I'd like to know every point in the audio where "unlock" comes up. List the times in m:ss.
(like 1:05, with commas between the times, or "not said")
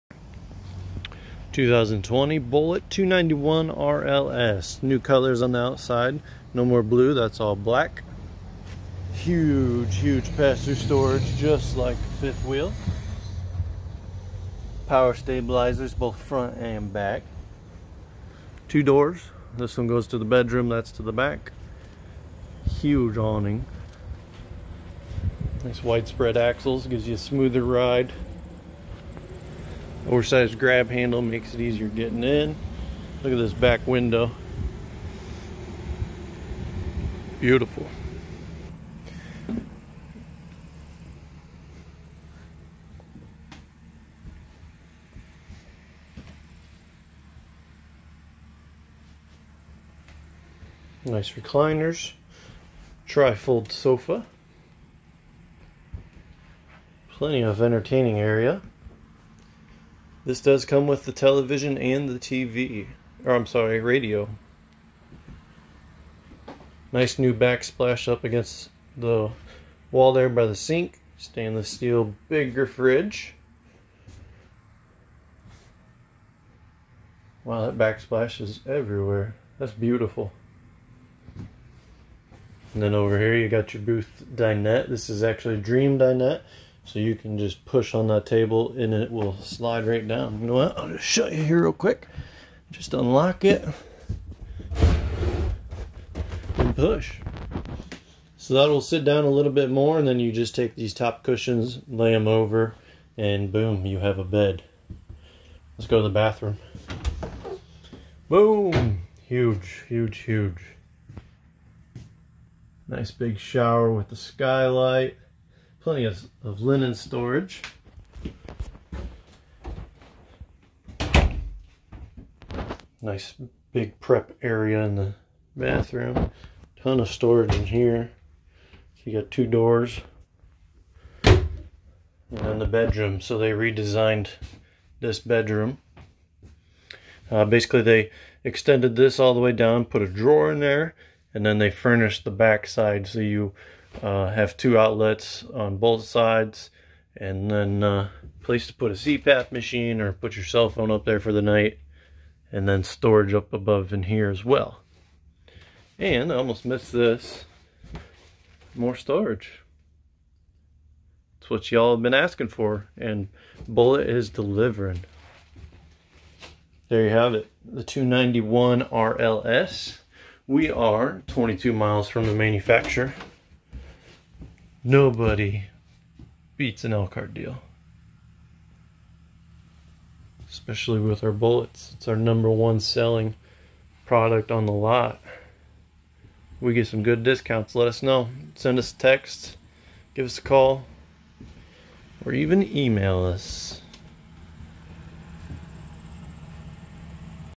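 1:32.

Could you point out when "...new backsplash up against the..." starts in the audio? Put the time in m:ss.
1:07.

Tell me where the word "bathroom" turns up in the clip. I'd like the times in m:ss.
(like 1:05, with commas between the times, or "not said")
1:46, 2:05.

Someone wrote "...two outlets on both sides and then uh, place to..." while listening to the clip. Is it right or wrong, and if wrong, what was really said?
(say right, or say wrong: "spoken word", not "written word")
right.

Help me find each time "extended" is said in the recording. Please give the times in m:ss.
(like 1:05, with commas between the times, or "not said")
2:18.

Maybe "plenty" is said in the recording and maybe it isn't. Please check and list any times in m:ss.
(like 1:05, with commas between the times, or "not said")
0:57, 1:55.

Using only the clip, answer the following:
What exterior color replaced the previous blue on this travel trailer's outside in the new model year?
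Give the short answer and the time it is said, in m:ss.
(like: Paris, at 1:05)
black, at 0:07.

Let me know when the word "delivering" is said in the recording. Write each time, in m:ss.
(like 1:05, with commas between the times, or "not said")
2:44.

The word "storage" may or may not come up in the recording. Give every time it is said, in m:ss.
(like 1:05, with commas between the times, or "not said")
0:10, 1:56, 2:07, 2:32, 2:38.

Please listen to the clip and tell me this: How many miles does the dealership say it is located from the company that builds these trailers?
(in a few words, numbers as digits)
22.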